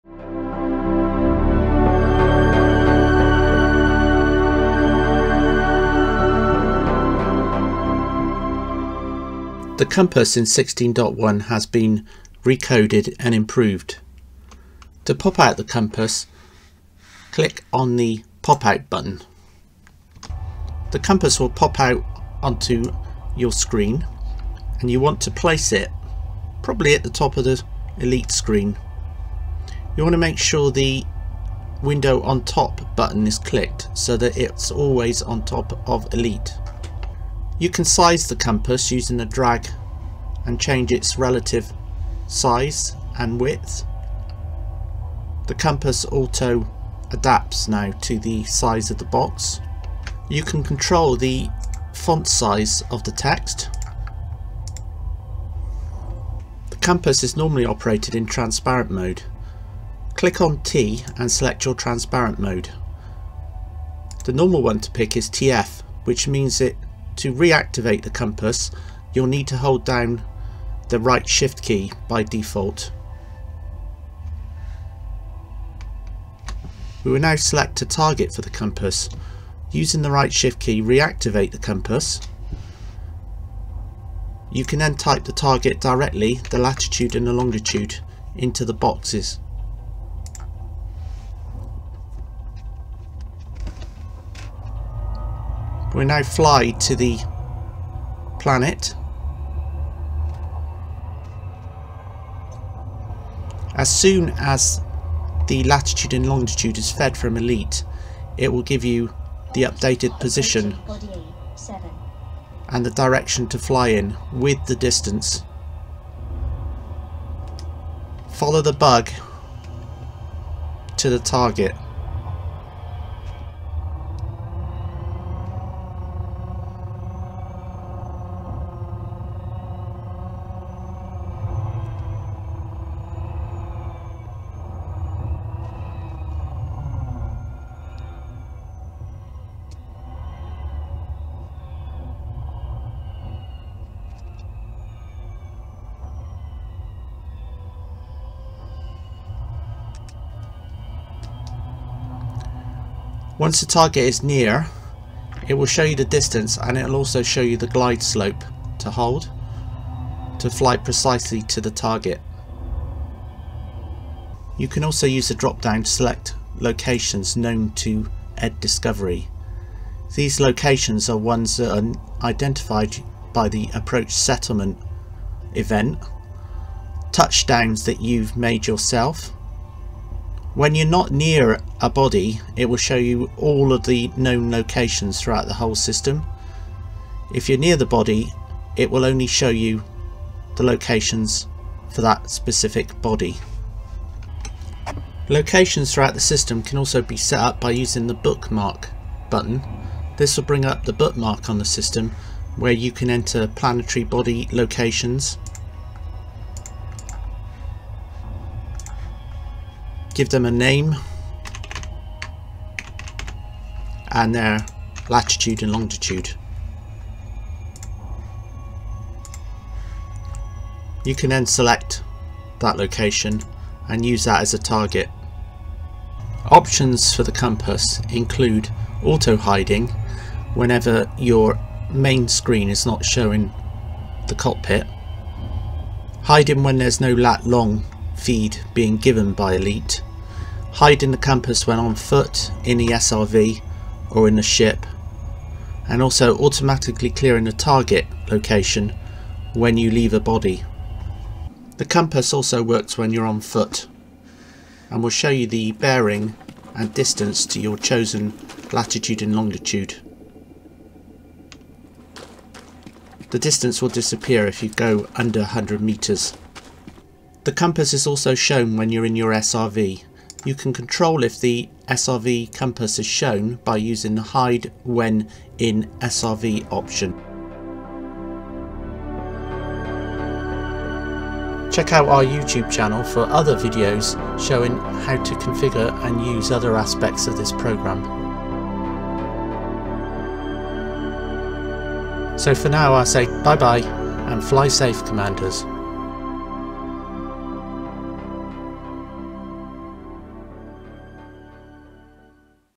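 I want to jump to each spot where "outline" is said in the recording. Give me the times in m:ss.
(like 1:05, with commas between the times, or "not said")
not said.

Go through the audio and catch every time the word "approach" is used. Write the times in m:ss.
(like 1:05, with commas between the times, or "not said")
2:53.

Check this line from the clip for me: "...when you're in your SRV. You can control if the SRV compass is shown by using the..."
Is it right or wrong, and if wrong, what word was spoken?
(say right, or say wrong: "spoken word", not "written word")
right.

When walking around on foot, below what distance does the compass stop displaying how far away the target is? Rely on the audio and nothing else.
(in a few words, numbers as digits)
100 metres.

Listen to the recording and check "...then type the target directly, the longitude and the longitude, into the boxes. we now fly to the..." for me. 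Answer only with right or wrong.
wrong.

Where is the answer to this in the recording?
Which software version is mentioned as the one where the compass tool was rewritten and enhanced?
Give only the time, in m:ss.
0:10.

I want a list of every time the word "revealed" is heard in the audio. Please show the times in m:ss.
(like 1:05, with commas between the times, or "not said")
not said.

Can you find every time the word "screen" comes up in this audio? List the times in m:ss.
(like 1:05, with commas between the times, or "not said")
0:23, 0:28, 3:52.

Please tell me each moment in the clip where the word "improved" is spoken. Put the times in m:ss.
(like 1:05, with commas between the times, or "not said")
0:13.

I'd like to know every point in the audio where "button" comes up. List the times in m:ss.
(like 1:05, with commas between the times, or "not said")
0:18, 0:32, 3:19.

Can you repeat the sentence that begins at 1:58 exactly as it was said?
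Follow the bug to the target.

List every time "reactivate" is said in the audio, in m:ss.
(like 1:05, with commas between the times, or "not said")
1:07, 1:20.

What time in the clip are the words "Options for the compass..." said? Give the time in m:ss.
3:46.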